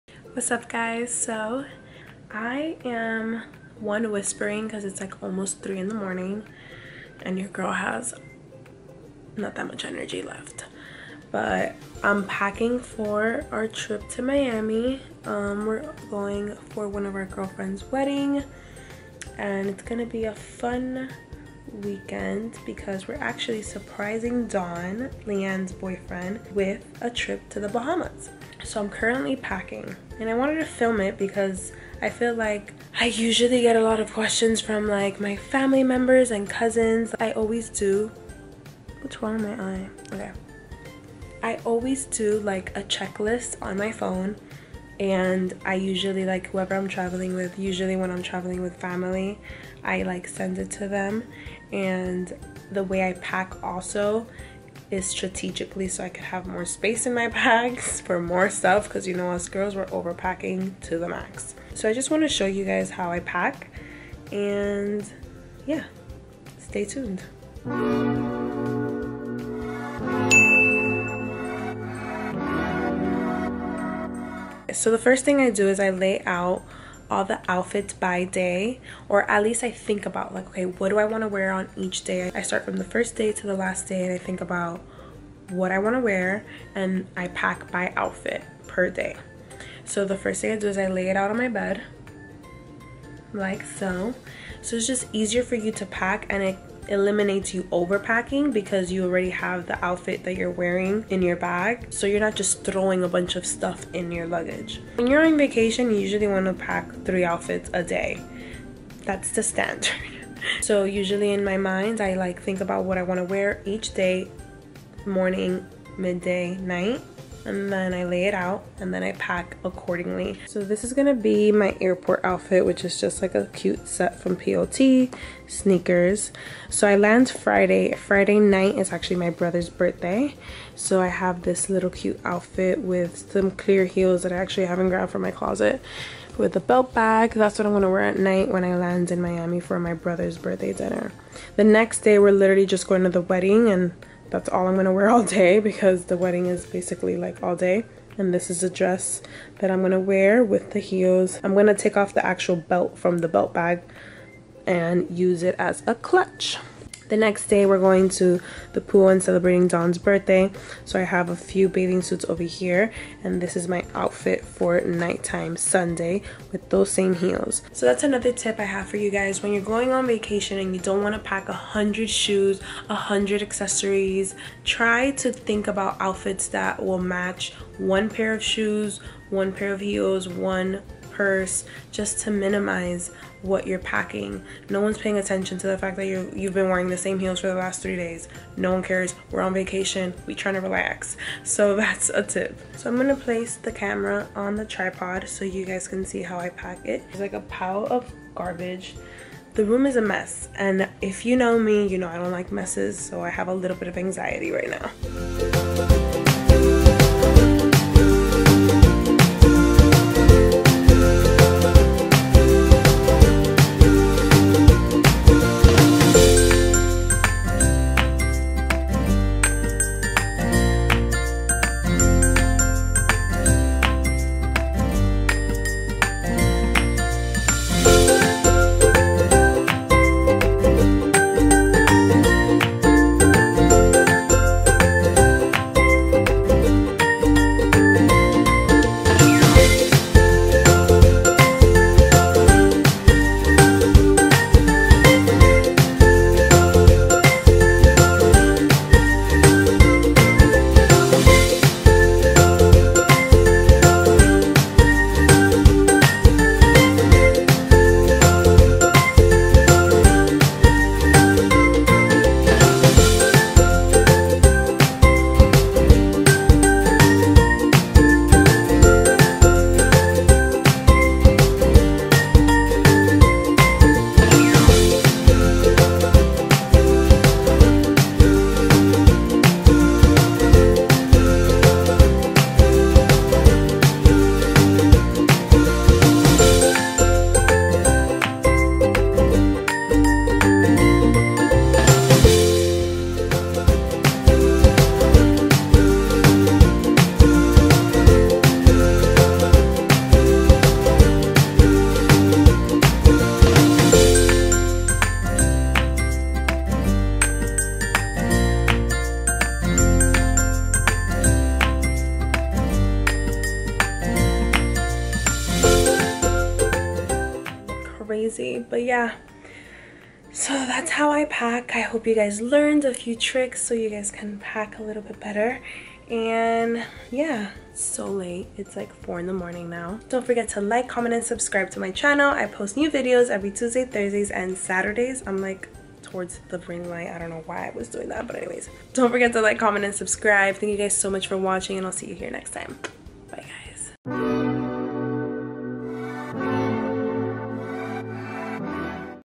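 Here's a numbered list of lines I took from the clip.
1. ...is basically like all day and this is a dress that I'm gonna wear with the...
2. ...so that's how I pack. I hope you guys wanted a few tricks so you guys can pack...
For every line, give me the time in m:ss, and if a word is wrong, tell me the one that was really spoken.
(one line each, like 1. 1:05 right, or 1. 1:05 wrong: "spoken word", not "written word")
1. 2:26 right
2. 5:20 wrong: "learned", not "wanted".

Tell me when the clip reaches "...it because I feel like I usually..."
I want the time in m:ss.
0:31.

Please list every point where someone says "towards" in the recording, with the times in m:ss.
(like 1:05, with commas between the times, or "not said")
5:36.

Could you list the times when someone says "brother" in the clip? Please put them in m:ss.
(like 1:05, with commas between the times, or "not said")
2:09, 2:19.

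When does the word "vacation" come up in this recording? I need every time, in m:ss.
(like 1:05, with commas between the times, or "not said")
1:45, 2:50, 3:09.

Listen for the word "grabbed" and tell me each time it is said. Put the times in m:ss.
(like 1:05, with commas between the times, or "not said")
2:14.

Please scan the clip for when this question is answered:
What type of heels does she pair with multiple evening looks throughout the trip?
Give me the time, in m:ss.
2:13.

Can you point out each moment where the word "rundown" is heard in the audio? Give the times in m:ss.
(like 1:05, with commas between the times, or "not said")
not said.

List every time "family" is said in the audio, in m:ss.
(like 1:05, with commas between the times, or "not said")
0:35, 0:48.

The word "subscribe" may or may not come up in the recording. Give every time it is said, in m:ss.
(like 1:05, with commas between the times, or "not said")
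5:31, 5:39.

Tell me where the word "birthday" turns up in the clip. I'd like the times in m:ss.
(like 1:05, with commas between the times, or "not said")
2:09, 2:20, 2:39.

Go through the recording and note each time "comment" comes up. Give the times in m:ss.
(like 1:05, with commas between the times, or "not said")
5:30, 5:39.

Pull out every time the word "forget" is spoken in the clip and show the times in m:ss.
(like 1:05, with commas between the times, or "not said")
5:30, 5:39.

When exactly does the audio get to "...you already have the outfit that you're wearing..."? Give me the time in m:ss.
1:38.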